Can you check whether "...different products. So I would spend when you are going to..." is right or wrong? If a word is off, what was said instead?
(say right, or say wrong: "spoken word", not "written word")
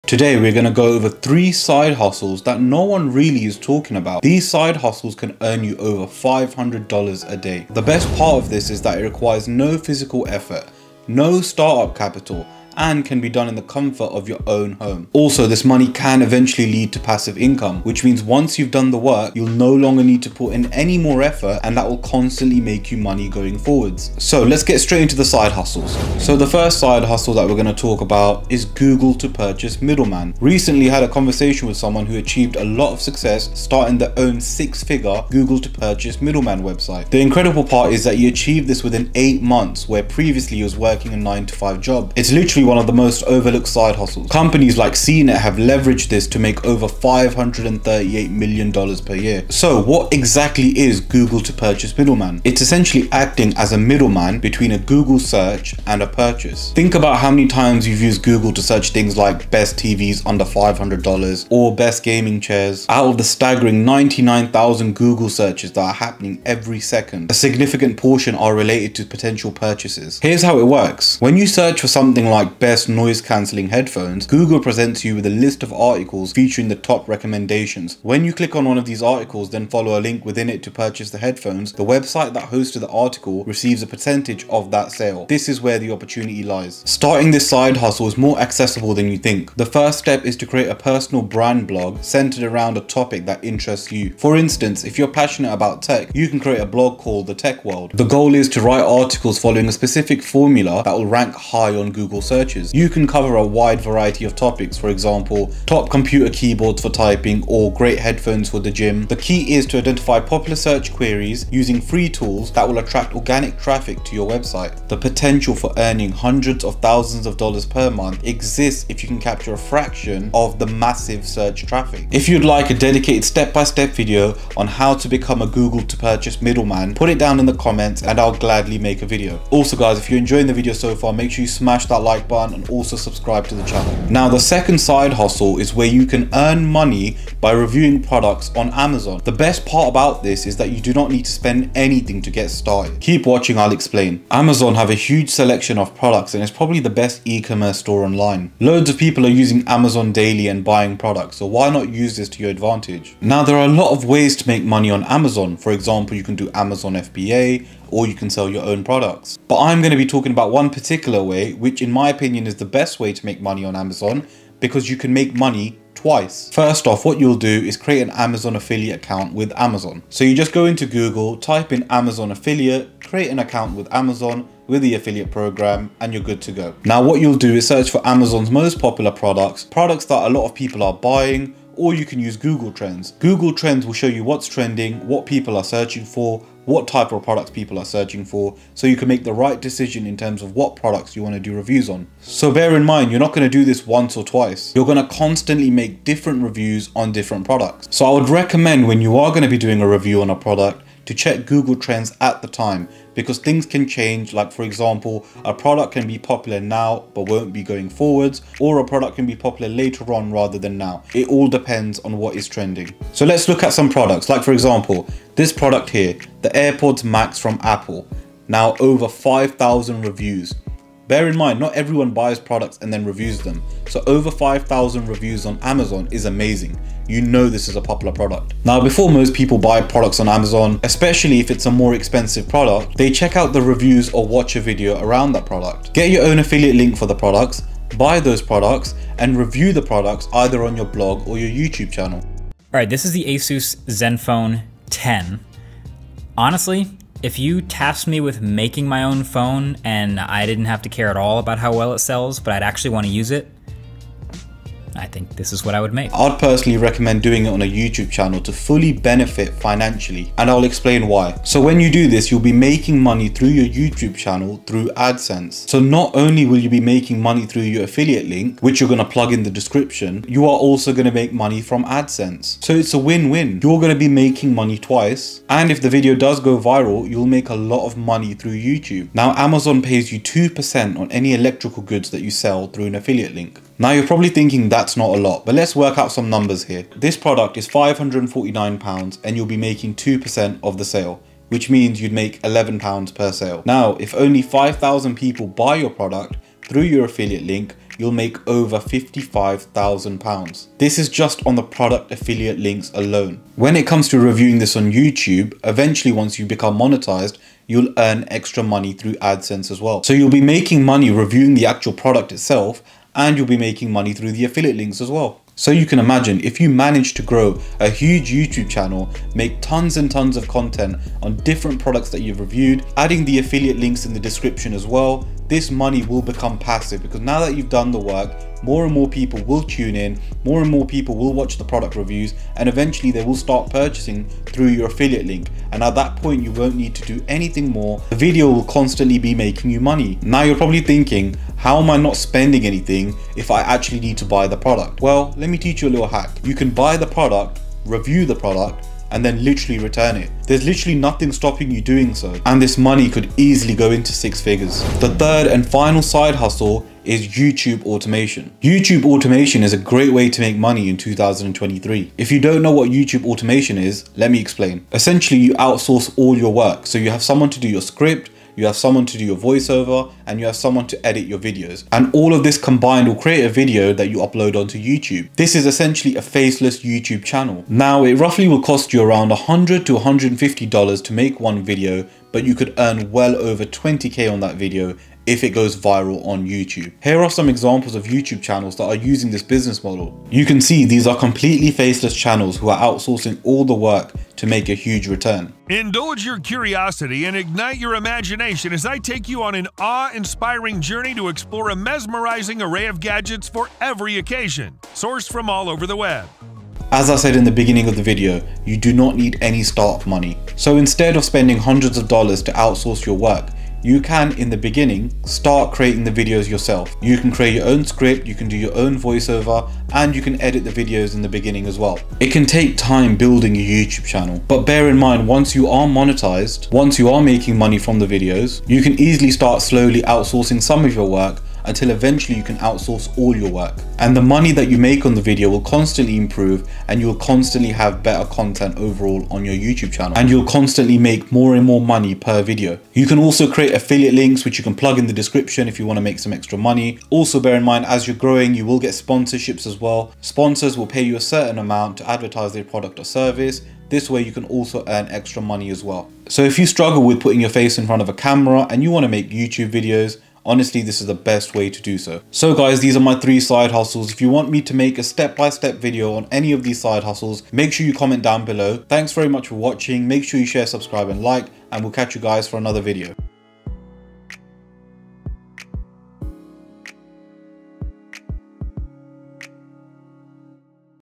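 wrong: "recommend", not "spend".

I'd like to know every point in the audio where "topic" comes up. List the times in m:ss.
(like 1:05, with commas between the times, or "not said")
1:32, 1:44.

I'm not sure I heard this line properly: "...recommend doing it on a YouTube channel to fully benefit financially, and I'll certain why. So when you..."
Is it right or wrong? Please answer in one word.
wrong.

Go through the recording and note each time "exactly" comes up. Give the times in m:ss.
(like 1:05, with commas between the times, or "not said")
0:50.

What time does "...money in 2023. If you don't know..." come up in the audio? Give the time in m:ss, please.
6:00.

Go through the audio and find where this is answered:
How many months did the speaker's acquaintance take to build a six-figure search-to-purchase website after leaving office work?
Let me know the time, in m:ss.
0:39.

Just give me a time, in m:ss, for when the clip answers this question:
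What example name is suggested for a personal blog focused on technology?
1:37.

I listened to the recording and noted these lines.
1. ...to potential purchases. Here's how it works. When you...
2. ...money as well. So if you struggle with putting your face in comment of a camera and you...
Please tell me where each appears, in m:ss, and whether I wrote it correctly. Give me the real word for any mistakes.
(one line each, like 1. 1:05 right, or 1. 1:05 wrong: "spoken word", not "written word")
1. 1:08 right
2. 7:35 wrong: "front", not "comment".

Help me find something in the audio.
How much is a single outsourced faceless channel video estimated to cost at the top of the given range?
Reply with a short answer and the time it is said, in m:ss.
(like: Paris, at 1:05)
$150, at 6:19.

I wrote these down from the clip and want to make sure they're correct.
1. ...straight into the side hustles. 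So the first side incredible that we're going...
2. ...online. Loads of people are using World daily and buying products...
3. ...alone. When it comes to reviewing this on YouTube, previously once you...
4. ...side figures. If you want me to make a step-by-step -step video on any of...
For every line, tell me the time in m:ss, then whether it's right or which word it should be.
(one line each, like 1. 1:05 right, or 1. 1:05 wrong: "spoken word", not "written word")
1. 0:24 wrong: "hustle", not "incredible"
2. 2:28 wrong: "Amazon", not "World"
3. 5:02 wrong: "eventually", not "previously"
4. 7:43 wrong: "hustles", not "figures".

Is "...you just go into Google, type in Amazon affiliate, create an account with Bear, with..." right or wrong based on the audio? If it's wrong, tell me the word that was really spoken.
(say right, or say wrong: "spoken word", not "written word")
wrong: "Amazon", not "Bear".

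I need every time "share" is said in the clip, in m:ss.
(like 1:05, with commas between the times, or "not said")
7:50.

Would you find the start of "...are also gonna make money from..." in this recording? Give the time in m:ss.
4:30.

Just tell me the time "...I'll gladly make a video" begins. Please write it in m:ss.
2:08.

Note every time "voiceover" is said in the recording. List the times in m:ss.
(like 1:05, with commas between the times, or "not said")
6:09, 6:58.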